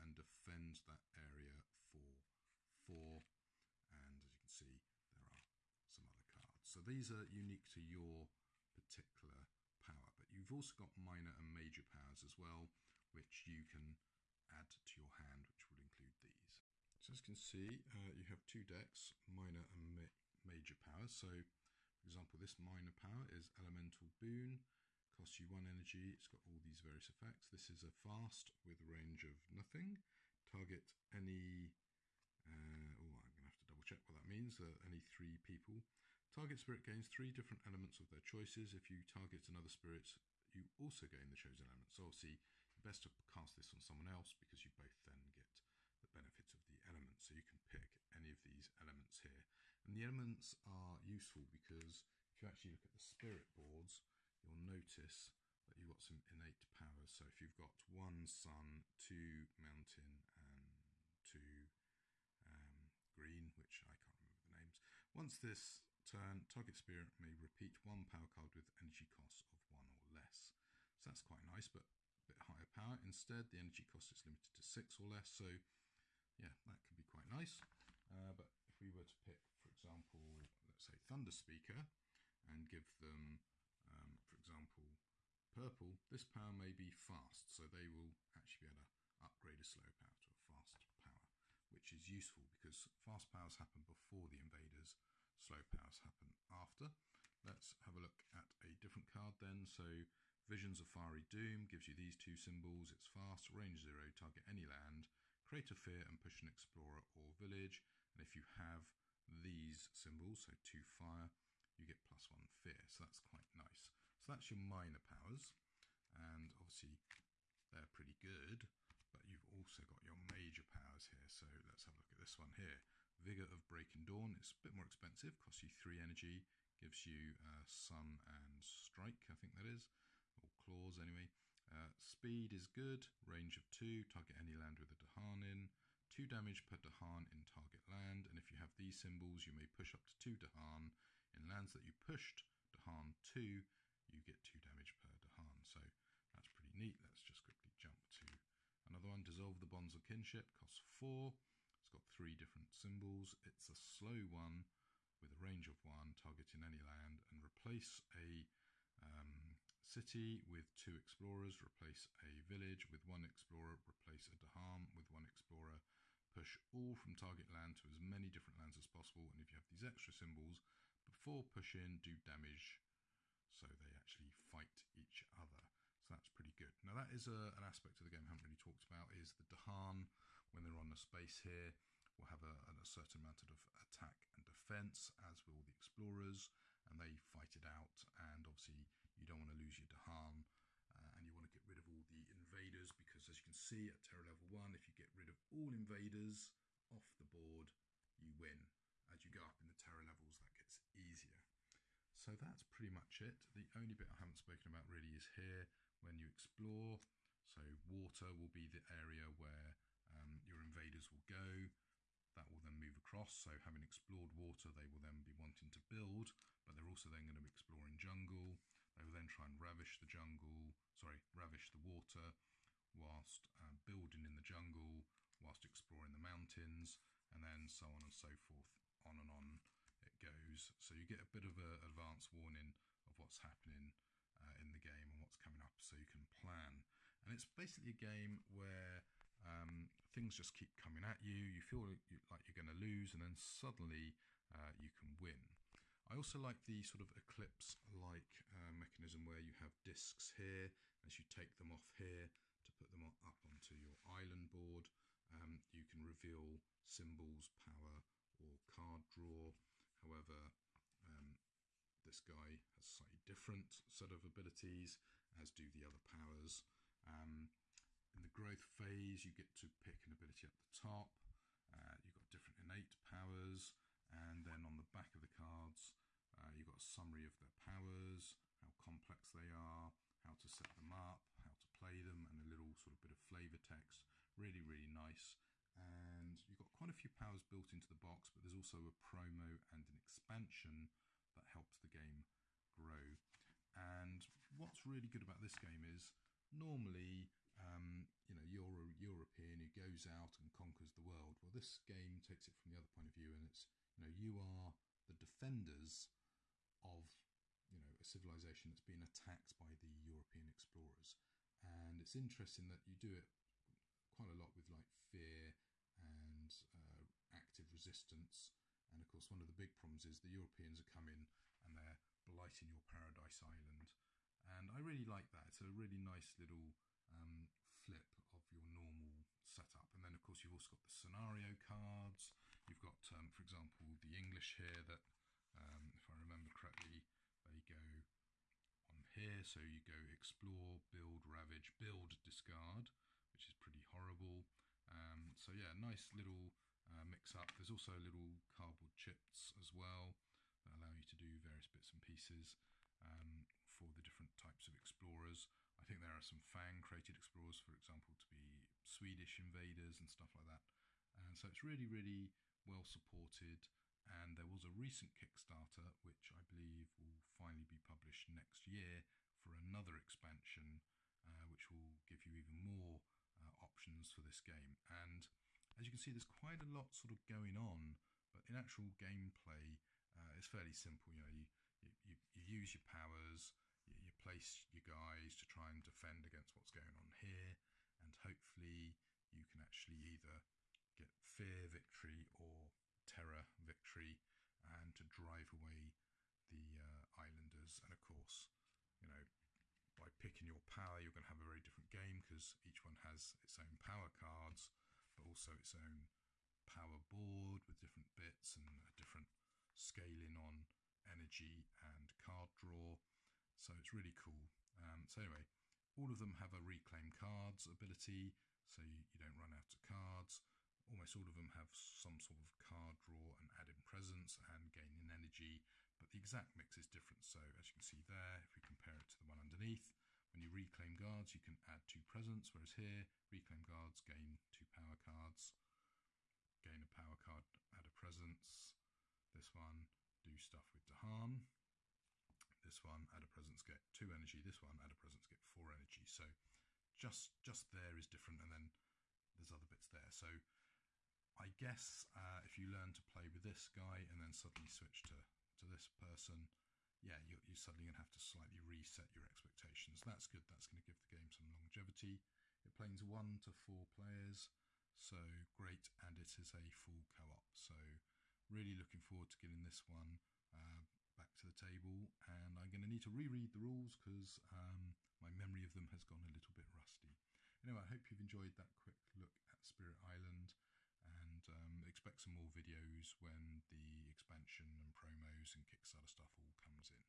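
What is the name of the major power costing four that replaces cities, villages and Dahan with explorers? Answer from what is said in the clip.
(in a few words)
Dissolve the Bonds of Kinship.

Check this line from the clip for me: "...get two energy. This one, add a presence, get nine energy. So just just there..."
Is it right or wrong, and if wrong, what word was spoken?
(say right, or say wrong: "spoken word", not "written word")
wrong: "four", not "nine".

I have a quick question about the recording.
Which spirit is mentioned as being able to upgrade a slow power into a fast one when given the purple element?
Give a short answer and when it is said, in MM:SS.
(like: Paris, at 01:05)
Thunder Speaker, at 01:20.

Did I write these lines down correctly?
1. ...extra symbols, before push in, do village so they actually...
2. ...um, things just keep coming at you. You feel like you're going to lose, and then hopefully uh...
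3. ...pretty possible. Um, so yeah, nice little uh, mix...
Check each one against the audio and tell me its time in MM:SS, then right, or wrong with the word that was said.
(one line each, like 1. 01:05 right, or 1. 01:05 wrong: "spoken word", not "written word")
1. 02:49 wrong: "damage", not "village"
2. 03:59 wrong: "suddenly", not "hopefully"
3. 05:43 wrong: "horrible", not "possible".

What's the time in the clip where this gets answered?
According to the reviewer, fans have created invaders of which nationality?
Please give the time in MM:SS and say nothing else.
05:58.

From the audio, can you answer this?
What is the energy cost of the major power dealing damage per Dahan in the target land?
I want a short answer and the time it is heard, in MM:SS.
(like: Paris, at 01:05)
3, at 02:05.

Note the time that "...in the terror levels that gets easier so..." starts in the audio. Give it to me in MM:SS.
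03:19.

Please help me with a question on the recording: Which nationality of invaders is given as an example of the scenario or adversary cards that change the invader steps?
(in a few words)
English.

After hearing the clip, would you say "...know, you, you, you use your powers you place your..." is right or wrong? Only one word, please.
right.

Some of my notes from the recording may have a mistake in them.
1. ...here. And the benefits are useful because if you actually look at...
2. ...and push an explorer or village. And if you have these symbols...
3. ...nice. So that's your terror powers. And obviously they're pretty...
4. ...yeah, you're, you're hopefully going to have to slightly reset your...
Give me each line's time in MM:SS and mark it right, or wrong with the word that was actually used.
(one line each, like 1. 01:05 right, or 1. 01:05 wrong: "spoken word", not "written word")
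1. 00:49 wrong: "elements", not "benefits"
2. 01:46 right
3. 01:53 wrong: "minor", not "terror"
4. 07:36 wrong: "suddenly", not "hopefully".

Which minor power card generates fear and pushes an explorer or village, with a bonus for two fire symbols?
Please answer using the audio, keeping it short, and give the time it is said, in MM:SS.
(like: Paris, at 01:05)
Visions of Fiery Doom, at 01:40.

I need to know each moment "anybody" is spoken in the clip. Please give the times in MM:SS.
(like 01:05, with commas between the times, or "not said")
not said.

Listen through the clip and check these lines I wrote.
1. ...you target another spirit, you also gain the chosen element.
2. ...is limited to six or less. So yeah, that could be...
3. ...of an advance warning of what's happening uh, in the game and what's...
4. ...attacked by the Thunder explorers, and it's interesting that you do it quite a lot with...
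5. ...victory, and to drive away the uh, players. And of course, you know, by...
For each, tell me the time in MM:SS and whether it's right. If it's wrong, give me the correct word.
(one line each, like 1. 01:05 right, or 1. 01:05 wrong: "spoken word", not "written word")
1. 00:38 right
2. 01:14 right
3. 03:51 right
4. 05:09 wrong: "European", not "Thunder"
5. 06:33 wrong: "islanders", not "players".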